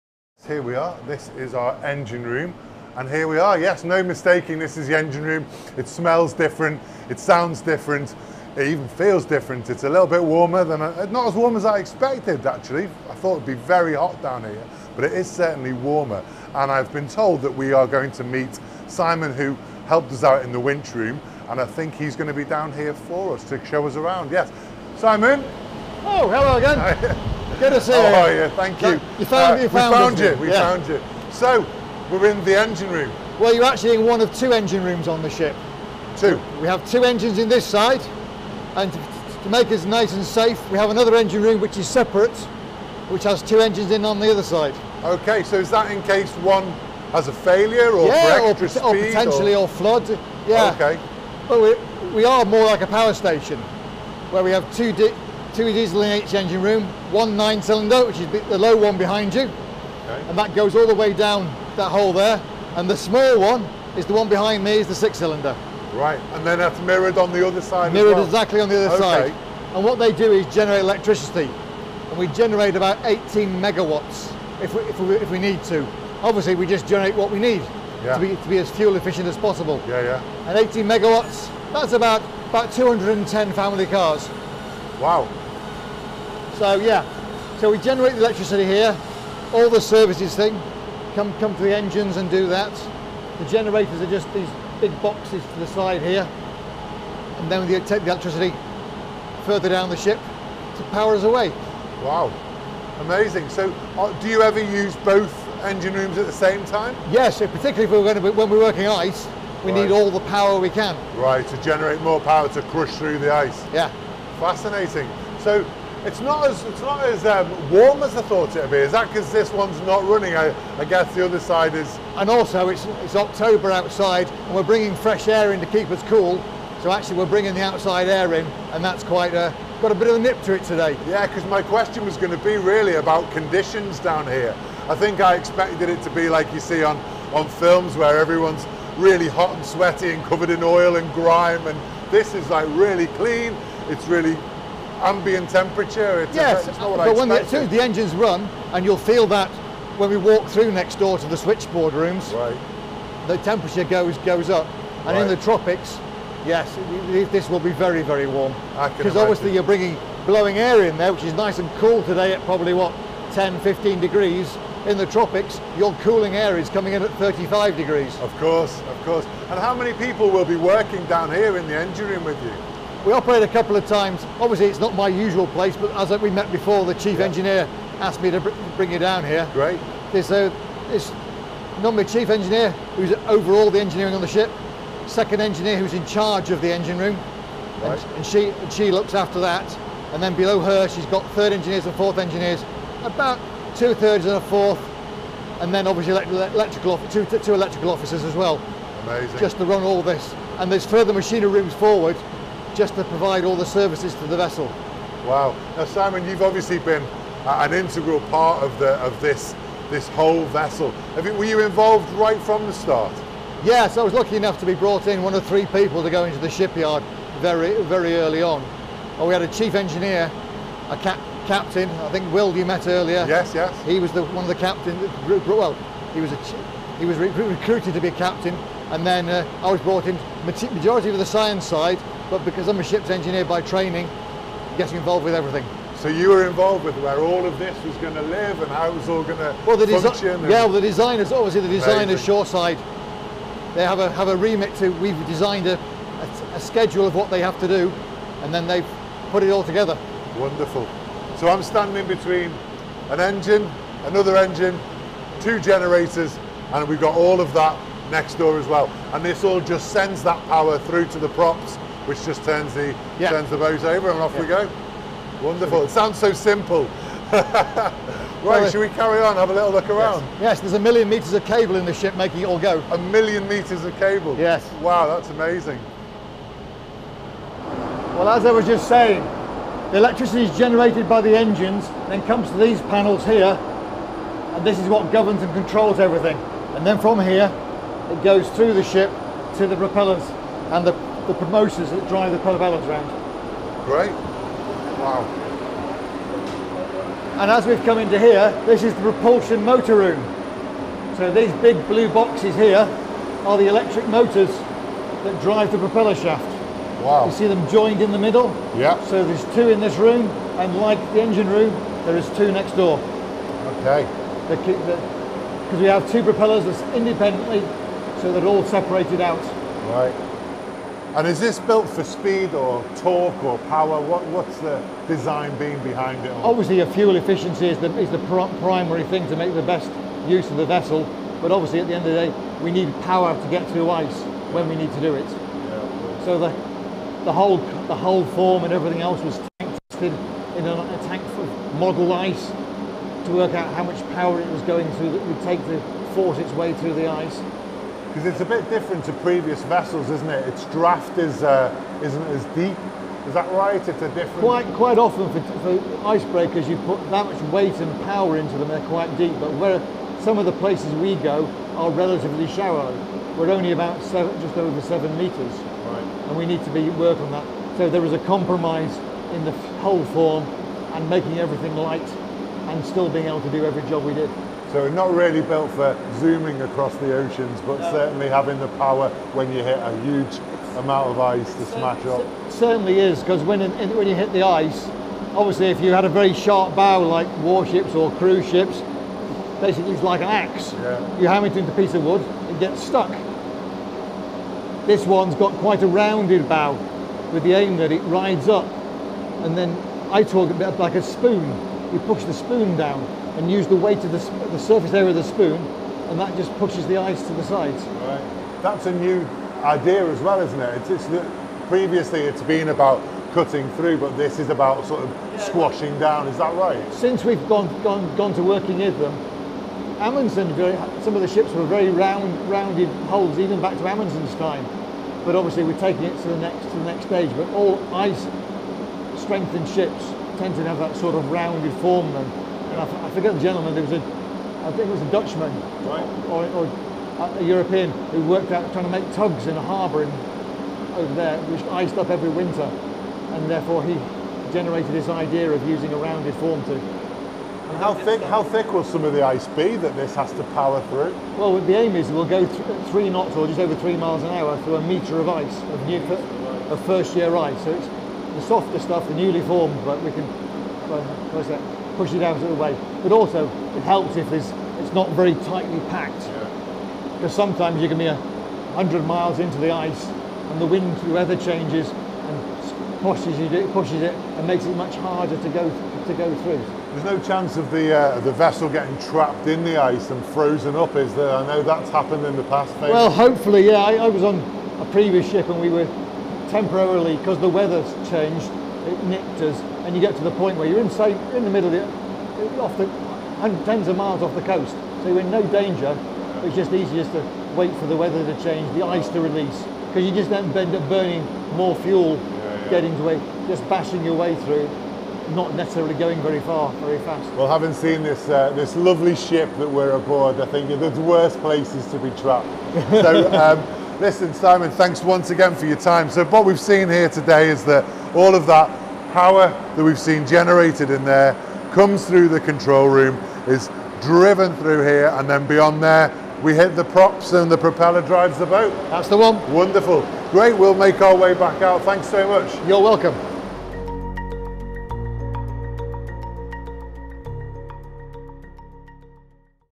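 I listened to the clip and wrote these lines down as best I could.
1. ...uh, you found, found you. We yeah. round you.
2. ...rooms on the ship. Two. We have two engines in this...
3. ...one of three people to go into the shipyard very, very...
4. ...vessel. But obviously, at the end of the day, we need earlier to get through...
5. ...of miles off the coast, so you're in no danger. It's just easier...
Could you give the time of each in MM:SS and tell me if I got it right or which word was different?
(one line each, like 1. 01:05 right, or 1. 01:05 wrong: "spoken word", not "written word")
1. 00:29 wrong: "found", not "round"
2. 00:34 right
3. 03:35 right
4. 05:30 wrong: "power", not "earlier"
5. 08:13 right.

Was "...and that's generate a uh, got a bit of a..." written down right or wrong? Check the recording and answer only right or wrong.
wrong.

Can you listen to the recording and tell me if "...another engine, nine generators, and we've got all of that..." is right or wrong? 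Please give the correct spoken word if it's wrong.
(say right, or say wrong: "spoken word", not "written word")
wrong: "two", not "nine".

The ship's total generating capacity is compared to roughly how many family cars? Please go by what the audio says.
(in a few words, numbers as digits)
210.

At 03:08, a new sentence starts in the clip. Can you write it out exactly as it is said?
and, and, she, and she looks after that.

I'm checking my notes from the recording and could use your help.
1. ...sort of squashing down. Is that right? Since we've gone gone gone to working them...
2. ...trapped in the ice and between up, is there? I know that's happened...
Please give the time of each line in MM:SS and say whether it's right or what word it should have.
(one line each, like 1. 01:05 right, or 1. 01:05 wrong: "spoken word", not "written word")
1. 06:54 right
2. 07:58 wrong: "frozen", not "between".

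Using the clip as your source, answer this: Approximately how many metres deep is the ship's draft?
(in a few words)
Just over 7 metres.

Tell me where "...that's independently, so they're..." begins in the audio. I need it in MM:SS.
05:16.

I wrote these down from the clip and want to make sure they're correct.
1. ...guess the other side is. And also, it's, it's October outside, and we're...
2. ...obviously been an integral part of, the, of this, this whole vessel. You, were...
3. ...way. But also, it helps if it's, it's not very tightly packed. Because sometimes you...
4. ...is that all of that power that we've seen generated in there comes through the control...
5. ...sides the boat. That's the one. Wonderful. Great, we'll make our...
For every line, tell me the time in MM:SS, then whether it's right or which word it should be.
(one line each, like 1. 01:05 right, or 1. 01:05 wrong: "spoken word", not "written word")
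1. 02:00 right
2. 03:26 right
3. 07:42 right
4. 08:37 right
5. 08:48 wrong: "drives", not "sides".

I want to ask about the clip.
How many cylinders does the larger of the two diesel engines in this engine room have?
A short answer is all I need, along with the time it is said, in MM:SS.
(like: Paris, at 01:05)
9, at 00:57.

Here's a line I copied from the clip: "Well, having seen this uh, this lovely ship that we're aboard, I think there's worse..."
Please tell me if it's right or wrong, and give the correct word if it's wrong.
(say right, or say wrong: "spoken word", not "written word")
right.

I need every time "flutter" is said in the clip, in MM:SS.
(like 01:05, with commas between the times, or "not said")
not said.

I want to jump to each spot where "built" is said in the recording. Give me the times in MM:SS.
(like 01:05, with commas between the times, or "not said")
05:21, 06:15.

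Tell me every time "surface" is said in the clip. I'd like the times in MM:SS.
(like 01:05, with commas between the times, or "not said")
06:44.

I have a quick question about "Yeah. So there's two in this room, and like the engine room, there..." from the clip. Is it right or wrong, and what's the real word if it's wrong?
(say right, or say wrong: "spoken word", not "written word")
right.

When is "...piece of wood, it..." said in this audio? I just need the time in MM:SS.
06:31.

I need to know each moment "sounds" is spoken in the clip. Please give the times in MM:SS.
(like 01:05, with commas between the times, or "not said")
00:07, 04:25.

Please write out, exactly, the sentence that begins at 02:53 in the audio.
We operated a couple of times.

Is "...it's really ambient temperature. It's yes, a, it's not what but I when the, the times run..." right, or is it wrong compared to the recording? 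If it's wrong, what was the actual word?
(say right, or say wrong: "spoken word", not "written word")
wrong: "engines", not "times".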